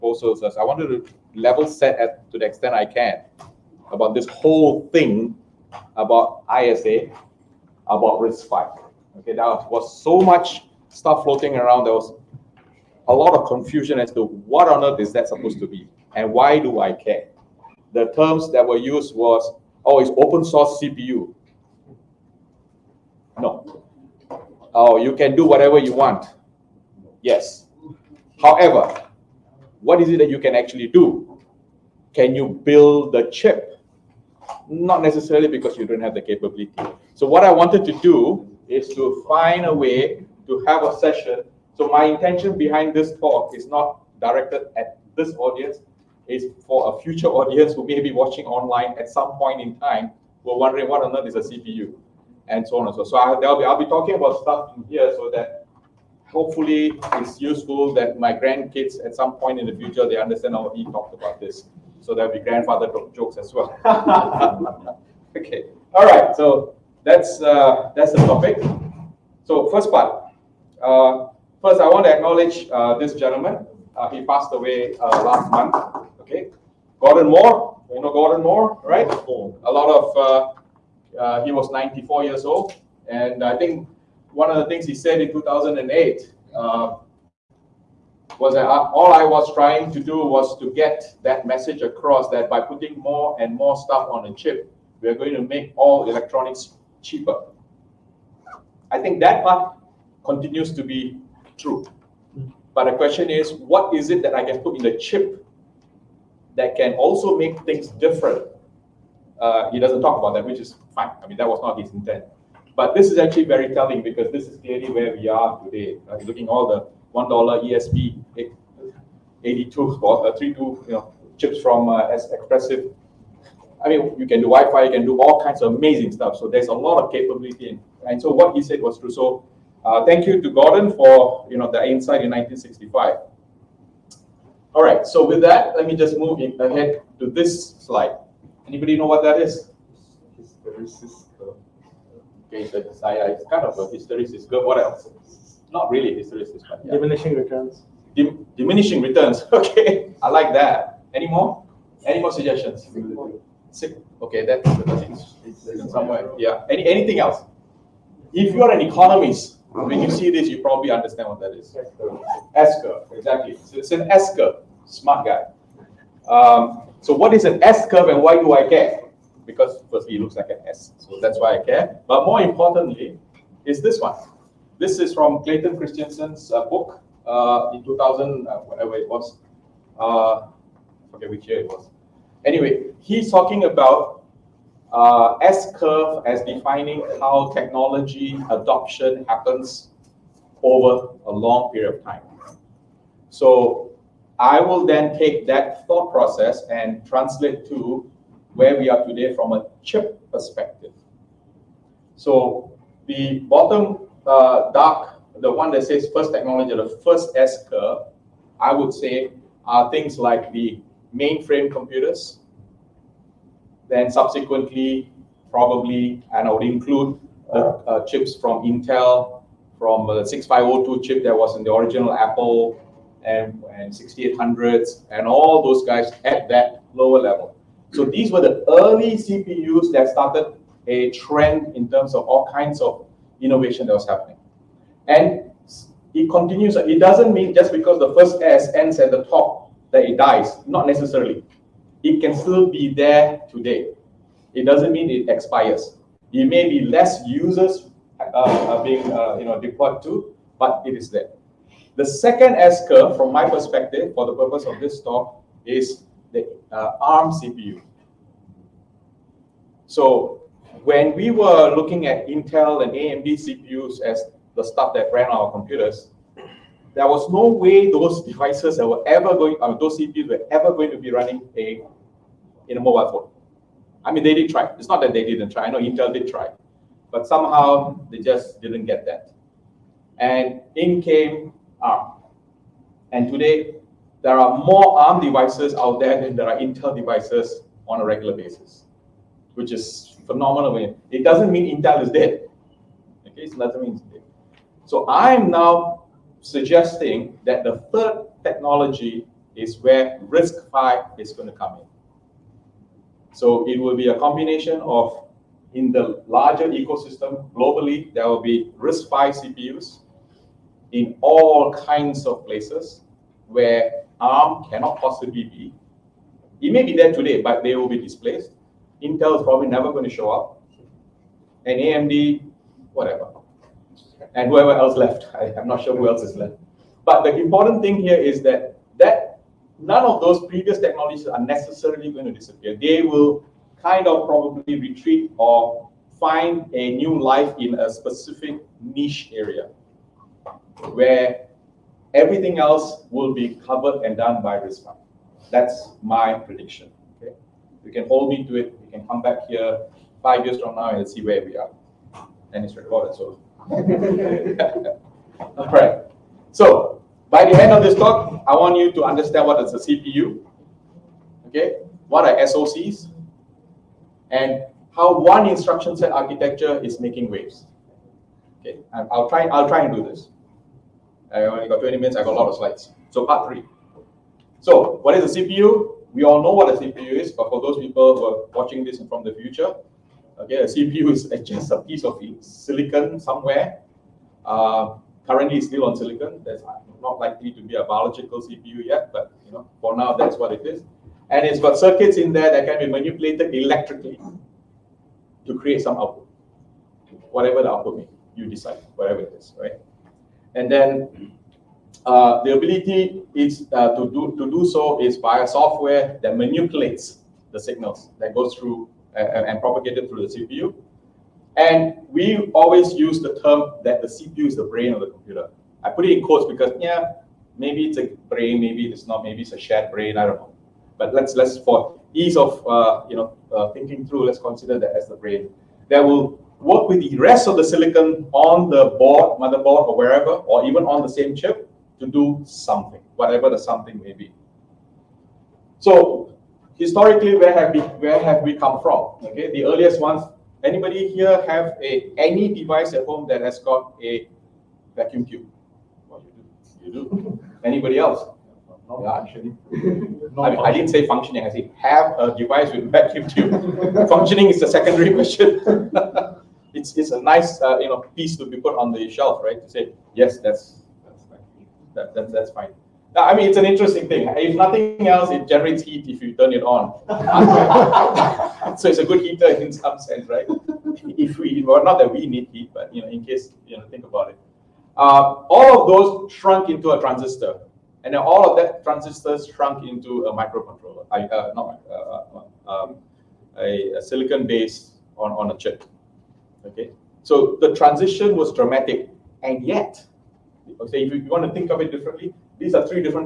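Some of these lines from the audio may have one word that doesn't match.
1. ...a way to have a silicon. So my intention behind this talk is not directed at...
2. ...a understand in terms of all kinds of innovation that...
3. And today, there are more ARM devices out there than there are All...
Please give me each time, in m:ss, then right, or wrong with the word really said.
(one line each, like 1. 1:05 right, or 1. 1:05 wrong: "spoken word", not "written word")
1. 0:39 wrong: "session", not "silicon"
2. 3:50 wrong: "trend", not "understand"
3. 4:43 wrong: "Intel", not "All".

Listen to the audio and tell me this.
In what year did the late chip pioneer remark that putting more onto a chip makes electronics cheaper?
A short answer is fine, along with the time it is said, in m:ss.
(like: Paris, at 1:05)
2008, at 1:25.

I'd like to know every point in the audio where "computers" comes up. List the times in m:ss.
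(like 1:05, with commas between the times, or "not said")
3:31, 4:25, 6:55.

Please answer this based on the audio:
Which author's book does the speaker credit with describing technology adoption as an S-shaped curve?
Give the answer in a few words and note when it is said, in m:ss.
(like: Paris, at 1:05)
Clayton Christensen, at 2:55.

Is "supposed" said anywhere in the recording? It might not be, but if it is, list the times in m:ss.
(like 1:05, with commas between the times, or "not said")
0:15.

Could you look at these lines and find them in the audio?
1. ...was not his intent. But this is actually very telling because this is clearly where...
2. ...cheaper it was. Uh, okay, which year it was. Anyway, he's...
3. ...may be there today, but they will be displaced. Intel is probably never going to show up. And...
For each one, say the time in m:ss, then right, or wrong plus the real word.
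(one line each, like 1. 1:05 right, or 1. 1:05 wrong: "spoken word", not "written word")
1. 1:51 right
2. 2:58 wrong: "whatever", not "cheaper"
3. 5:16 right.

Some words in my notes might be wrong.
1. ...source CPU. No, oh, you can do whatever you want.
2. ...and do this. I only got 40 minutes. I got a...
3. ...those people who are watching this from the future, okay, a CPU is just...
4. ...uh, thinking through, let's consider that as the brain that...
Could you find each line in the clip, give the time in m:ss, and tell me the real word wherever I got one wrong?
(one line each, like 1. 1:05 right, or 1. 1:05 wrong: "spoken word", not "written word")
1. 0:20 right
2. 6:09 wrong: "20", not "40"
3. 6:17 right
4. 7:03 right.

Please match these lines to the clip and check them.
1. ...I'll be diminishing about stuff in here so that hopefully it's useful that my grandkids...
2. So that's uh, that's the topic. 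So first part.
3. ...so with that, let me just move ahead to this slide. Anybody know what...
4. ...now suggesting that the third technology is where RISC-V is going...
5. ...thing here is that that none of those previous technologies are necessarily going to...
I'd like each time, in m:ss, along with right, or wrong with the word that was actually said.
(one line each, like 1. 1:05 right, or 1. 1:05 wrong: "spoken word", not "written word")
1. 0:53 wrong: "talking", not "diminishing"
2. 1:06 right
3. 2:15 right
4. 4:55 right
5. 5:27 right.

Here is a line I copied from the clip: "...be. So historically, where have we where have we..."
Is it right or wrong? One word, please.
right.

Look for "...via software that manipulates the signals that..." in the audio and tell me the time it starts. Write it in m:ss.
6:45.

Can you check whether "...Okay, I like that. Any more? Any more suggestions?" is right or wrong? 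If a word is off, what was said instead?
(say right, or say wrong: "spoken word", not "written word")
right.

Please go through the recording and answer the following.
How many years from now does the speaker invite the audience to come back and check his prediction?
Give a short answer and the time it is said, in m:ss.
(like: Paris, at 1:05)
5, at 5:50.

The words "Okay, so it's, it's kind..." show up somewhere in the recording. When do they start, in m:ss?
2:22.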